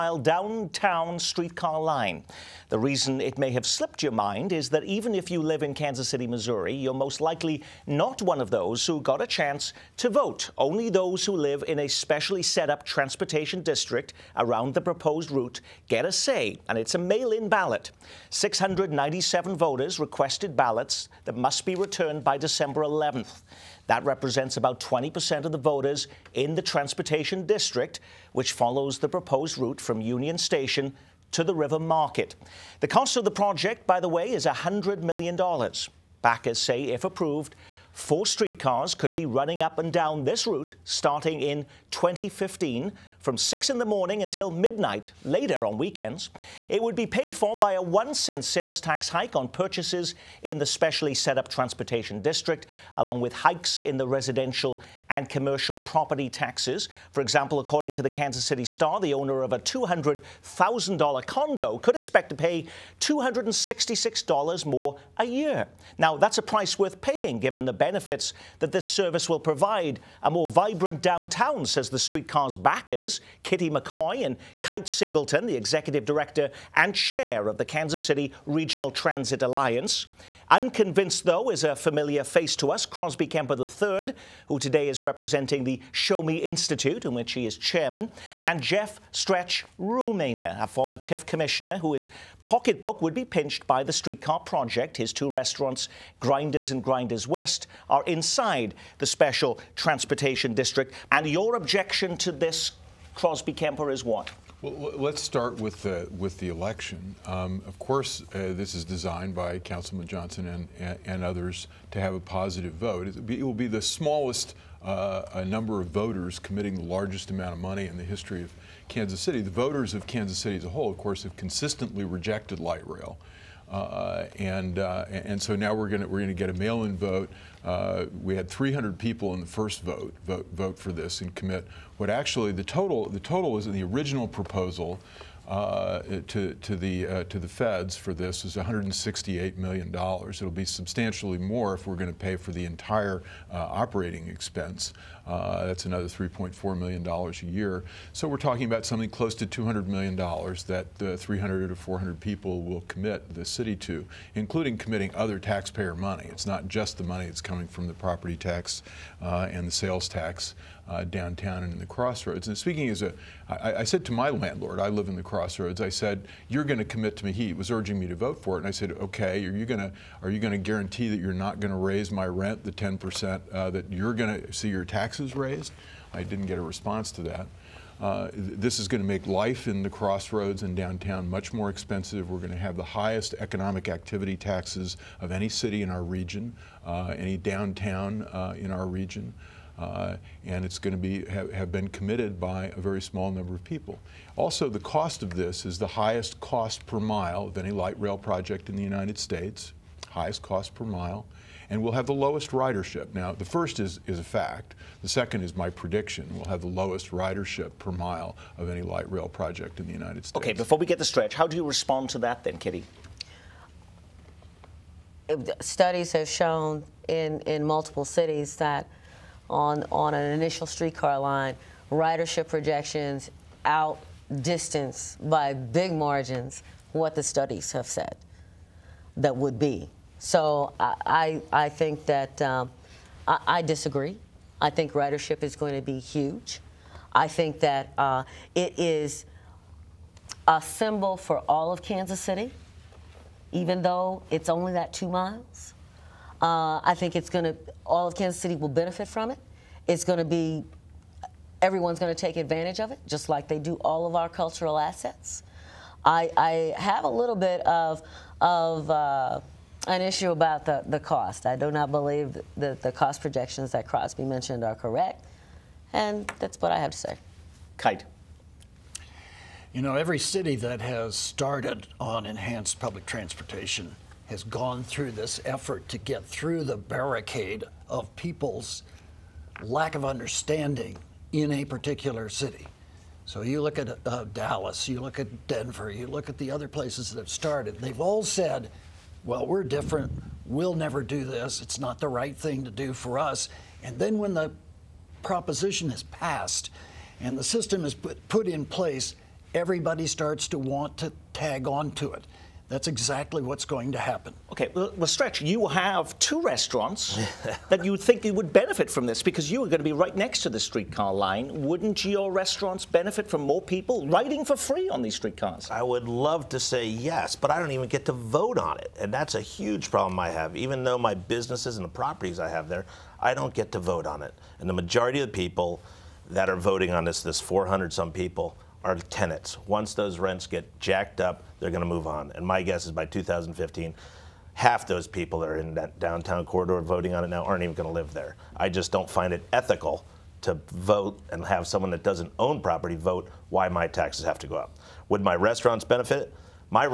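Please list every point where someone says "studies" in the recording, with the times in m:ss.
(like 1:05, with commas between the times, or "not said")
3:35, 3:47.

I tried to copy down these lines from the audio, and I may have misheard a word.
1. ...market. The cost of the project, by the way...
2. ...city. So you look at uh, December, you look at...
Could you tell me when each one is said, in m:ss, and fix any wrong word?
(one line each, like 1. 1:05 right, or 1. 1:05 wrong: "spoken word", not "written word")
1. 0:31 right
2. 4:42 wrong: "Dallas", not "December".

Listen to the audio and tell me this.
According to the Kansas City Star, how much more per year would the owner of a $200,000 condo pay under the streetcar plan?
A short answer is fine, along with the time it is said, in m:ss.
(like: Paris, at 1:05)
$266, at 1:03.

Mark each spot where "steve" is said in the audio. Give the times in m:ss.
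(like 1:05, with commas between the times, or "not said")
not said.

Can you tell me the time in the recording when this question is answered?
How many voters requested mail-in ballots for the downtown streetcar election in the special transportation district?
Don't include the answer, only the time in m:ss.
0:18.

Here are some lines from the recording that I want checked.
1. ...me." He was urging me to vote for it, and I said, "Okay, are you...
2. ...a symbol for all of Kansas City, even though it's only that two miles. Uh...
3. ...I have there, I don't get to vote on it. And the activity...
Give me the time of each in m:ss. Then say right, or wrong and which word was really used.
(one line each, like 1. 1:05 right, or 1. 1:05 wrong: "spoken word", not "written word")
1. 2:47 right
2. 4:00 right
3. 5:22 wrong: "majority", not "activity".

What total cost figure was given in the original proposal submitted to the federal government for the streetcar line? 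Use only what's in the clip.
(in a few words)
$168 million.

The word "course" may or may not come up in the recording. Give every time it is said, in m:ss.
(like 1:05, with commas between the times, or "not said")
1:47, 2:00.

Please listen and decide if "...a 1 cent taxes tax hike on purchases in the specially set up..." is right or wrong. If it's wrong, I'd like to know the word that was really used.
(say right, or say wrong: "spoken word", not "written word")
wrong: "sales", not "taxes".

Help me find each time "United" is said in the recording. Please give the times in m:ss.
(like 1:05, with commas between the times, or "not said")
3:18, 3:29.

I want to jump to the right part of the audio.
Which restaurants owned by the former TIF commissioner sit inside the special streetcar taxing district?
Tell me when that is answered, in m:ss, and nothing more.
1:36.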